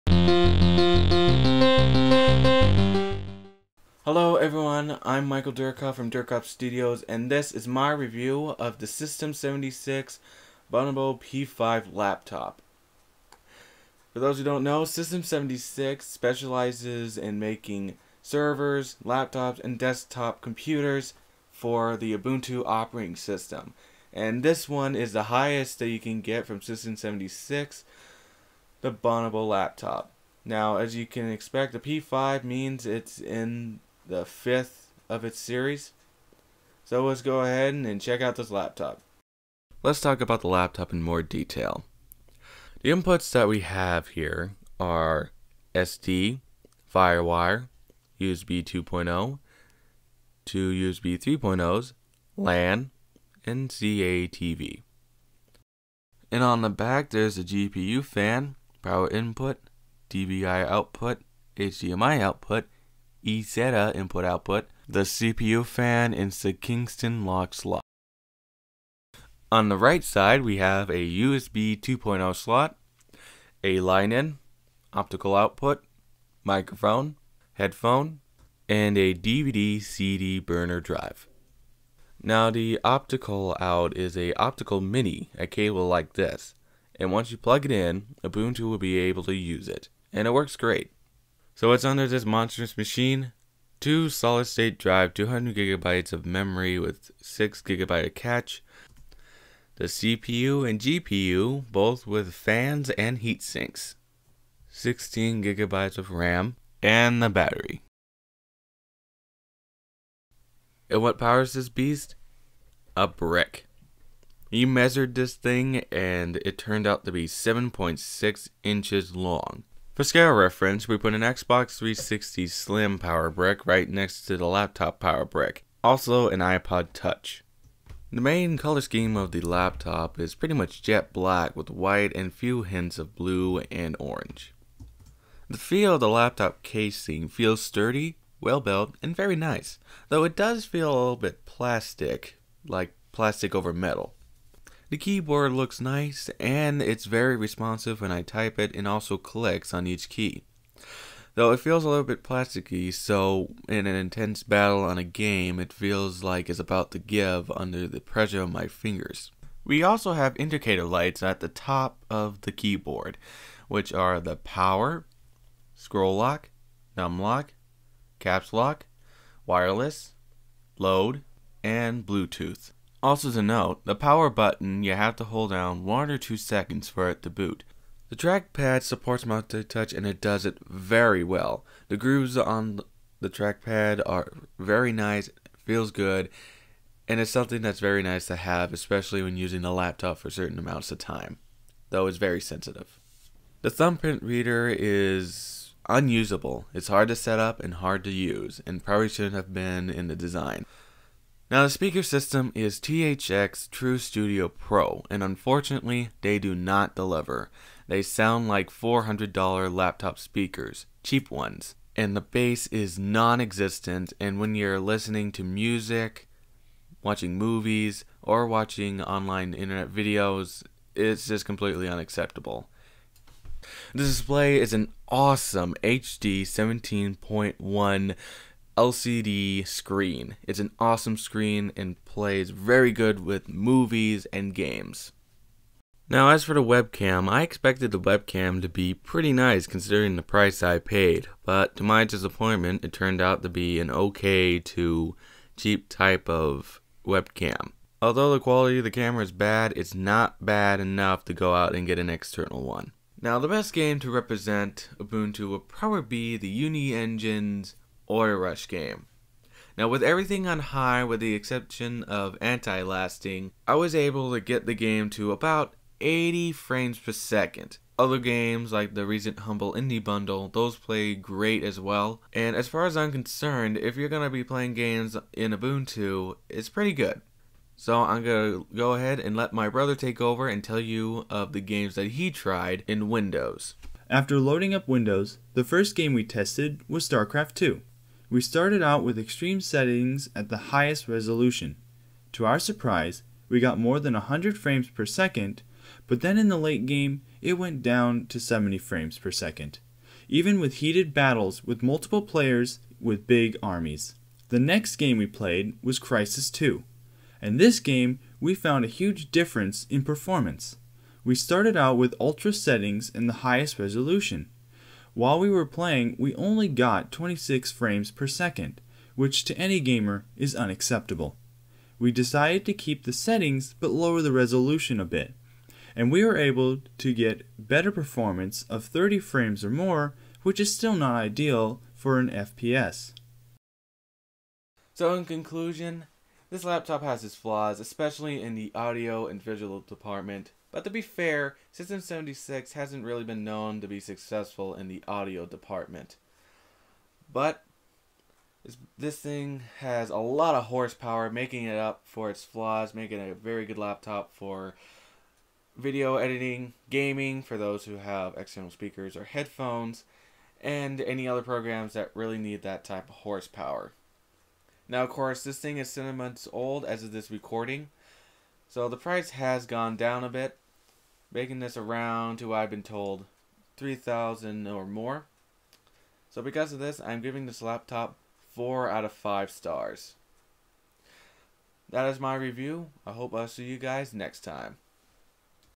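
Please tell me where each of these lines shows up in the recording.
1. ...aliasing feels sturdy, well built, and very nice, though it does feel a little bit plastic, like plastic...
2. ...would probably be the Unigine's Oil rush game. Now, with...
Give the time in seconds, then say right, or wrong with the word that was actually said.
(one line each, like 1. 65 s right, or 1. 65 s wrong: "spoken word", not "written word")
1. 136 s wrong: "casing", not "aliasing"
2. 255 s right.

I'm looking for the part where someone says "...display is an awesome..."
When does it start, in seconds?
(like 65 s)
224 s.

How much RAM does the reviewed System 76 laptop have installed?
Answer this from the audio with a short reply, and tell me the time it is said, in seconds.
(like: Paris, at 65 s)
16 gigabytes, at 104 s.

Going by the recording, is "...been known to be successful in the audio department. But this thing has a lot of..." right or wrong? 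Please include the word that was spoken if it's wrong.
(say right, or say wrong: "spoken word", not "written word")
right.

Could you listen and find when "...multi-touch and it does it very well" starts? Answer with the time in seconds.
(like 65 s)
179 s.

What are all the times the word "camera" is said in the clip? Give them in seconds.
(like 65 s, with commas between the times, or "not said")
248 s.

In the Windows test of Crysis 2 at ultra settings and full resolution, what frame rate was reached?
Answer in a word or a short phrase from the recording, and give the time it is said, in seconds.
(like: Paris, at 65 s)
26 frames per second, at 317 s.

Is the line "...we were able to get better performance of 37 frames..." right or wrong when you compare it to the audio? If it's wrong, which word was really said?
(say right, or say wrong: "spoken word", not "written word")
wrong: "30", not "37".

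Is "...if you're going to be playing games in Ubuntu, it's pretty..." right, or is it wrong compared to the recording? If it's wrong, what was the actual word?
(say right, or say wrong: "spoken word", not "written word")
right.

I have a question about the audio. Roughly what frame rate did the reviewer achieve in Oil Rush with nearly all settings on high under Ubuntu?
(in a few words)
80 frames per second.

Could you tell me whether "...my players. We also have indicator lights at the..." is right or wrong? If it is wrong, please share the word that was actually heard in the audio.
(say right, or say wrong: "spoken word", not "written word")
wrong: "fingers", not "players".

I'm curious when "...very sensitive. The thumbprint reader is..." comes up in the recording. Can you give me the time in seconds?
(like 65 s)
192 s.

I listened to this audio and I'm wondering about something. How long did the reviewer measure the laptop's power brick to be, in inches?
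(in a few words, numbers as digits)
7.6 inches.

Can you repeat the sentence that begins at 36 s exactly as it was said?
So let's go ahead and check out this laptop.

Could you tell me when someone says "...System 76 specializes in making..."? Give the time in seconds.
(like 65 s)
14 s.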